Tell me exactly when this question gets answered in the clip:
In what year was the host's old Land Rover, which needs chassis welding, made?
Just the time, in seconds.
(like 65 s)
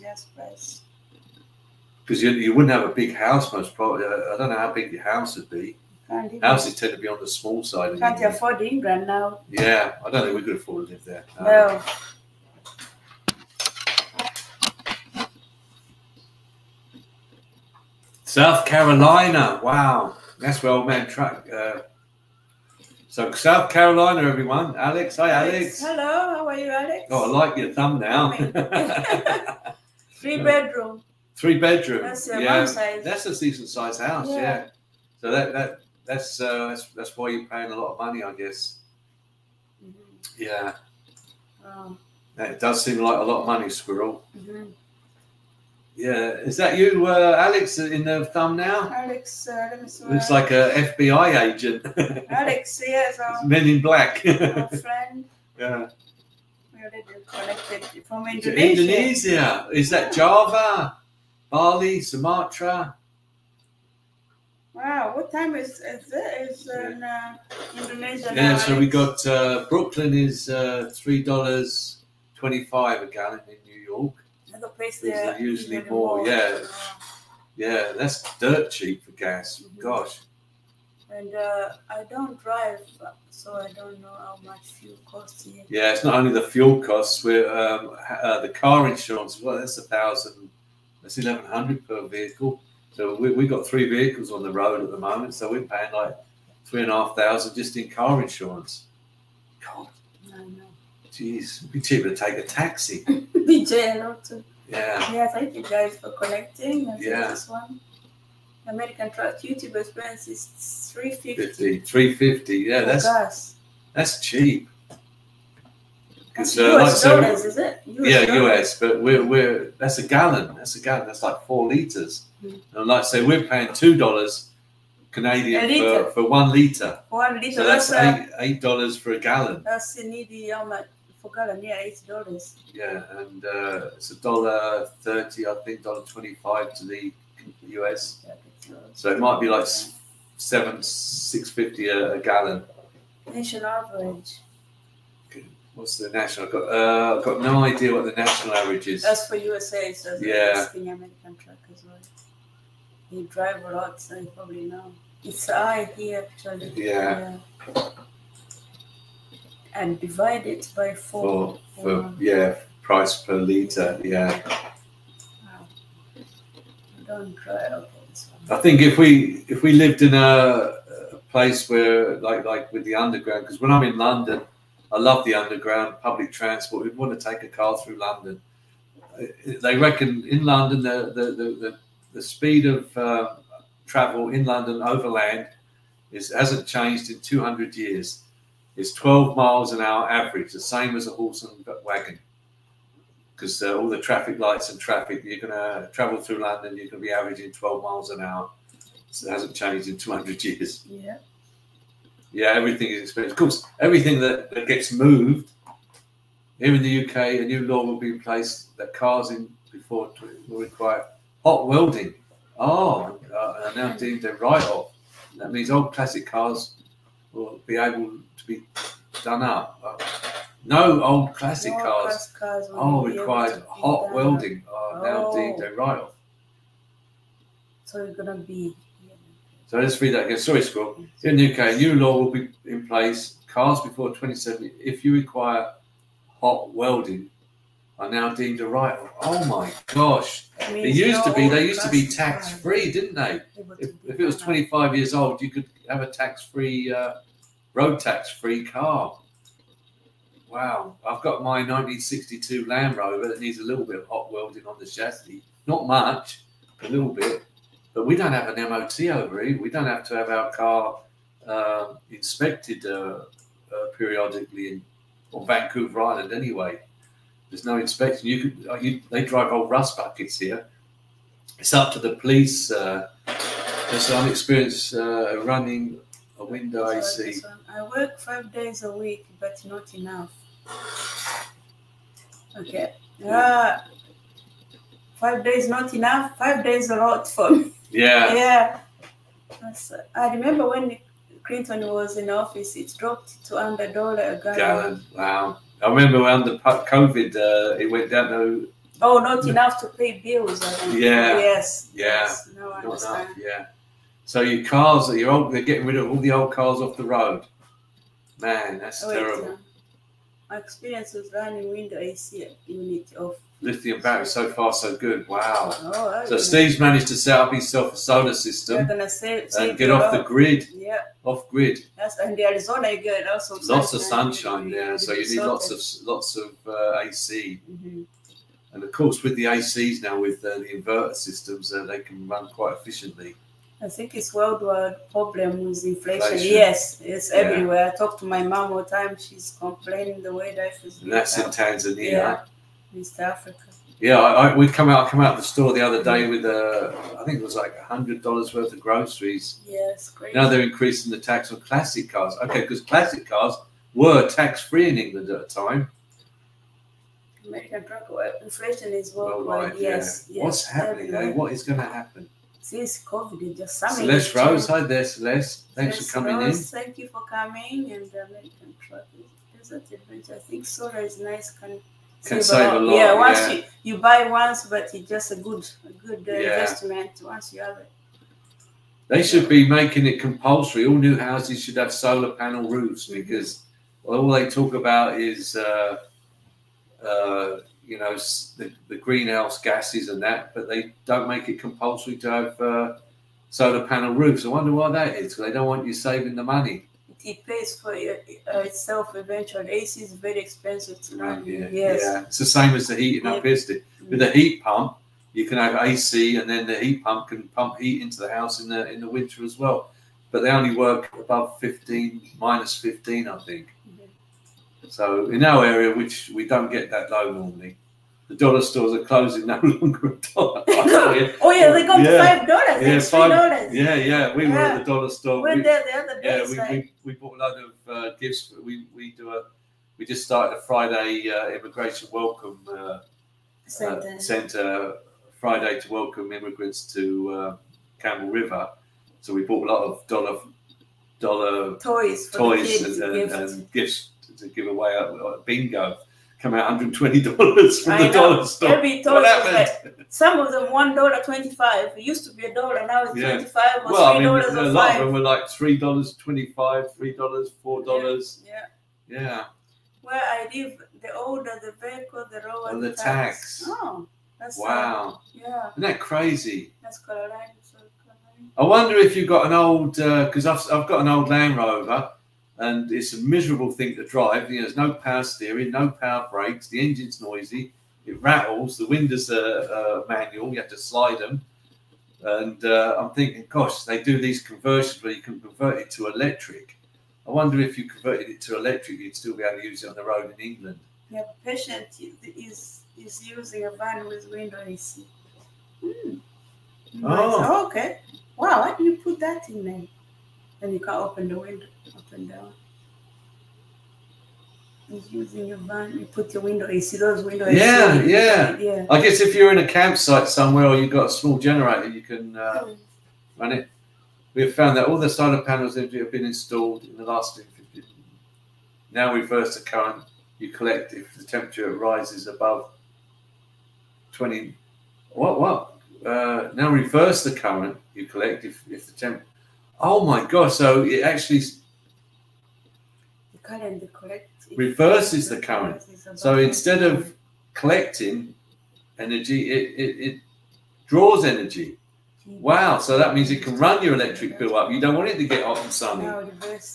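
251 s.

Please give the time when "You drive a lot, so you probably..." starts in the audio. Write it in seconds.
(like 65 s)
153 s.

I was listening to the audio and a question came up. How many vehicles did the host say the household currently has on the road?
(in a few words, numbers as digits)
3.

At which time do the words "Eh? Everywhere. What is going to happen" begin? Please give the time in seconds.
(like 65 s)
361 s.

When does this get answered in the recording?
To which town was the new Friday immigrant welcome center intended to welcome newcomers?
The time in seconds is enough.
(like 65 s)
437 s.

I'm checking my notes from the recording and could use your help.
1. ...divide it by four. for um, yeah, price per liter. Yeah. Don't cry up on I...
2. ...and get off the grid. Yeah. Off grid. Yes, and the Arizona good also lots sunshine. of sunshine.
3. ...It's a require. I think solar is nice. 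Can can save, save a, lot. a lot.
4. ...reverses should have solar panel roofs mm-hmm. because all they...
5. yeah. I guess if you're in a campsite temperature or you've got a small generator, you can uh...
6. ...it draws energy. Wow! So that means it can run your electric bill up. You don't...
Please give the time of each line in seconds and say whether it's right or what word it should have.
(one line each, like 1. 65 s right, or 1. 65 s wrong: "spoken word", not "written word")
1. 159 s right
2. 319 s right
3. 369 s wrong: "adventure", not "require"
4. 381 s wrong: "houses", not "reverses"
5. 508 s wrong: "somewhere", not "temperature"
6. 540 s right.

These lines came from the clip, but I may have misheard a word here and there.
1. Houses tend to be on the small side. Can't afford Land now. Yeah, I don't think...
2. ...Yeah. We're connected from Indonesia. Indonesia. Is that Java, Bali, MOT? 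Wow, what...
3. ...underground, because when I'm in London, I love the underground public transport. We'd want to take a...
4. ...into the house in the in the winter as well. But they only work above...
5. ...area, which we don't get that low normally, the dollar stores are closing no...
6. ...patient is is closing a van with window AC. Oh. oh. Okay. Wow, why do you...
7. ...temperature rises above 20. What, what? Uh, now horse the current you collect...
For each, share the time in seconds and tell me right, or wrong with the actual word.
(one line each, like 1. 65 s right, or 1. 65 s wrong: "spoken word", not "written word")
1. 6 s wrong: "England", not "Land"
2. 55 s wrong: "Sumatra", not "MOT"
3. 172 s right
4. 408 s right
5. 415 s right
6. 491 s wrong: "using", not "closing"
7. 521 s wrong: "reverse", not "horse".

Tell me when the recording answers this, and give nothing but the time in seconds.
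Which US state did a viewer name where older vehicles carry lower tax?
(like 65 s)
466 s.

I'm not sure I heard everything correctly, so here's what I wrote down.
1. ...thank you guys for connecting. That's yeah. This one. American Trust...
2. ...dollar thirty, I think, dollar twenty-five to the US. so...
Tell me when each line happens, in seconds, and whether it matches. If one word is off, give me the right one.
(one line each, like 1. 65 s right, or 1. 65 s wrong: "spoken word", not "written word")
1. 105 s right
2. 134 s right.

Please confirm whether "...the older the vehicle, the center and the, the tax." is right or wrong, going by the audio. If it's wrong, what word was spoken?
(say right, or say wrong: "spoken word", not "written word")
wrong: "lower", not "center".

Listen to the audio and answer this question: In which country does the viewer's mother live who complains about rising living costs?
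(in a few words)
Tanzania.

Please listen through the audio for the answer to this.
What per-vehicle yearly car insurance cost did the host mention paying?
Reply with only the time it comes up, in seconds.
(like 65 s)
91 s.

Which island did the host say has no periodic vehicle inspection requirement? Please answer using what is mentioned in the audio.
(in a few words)
Vancouver Island.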